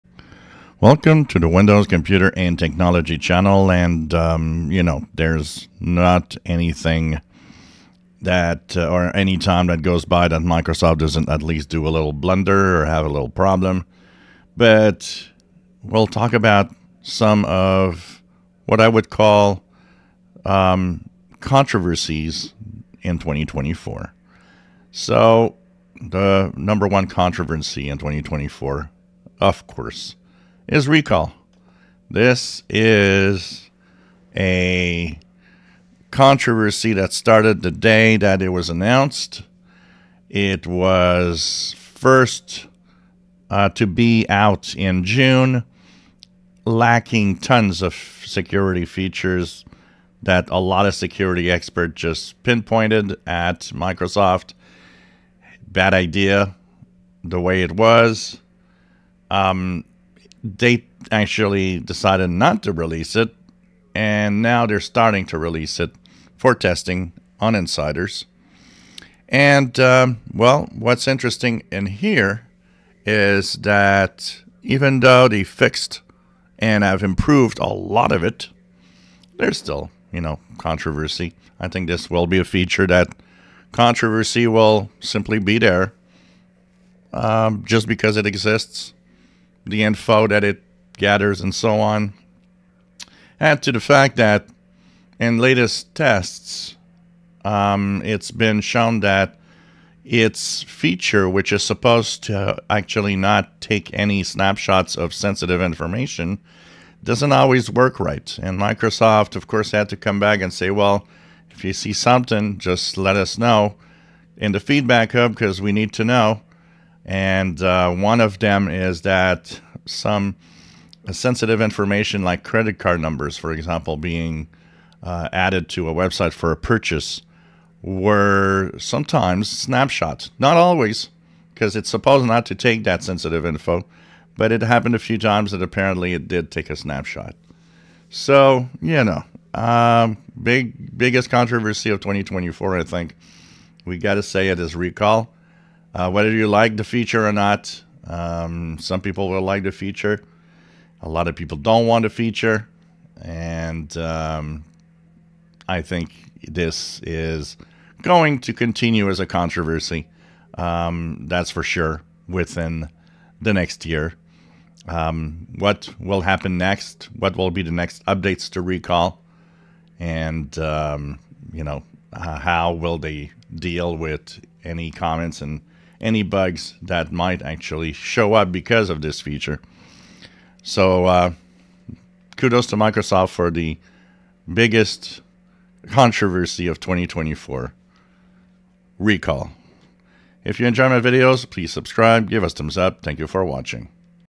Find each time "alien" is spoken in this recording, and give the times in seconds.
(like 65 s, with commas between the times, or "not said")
not said.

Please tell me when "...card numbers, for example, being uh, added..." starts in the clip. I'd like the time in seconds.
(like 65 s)
122 s.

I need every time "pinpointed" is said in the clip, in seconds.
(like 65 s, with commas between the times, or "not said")
52 s.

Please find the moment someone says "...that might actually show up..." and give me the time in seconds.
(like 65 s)
176 s.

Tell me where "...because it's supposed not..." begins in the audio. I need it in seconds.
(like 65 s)
131 s.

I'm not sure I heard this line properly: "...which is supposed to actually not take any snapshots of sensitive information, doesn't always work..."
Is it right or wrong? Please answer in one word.
right.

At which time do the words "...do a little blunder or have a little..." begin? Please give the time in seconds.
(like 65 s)
11 s.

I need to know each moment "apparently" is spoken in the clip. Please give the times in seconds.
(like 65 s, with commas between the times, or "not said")
135 s.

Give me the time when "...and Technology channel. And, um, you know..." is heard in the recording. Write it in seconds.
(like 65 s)
2 s.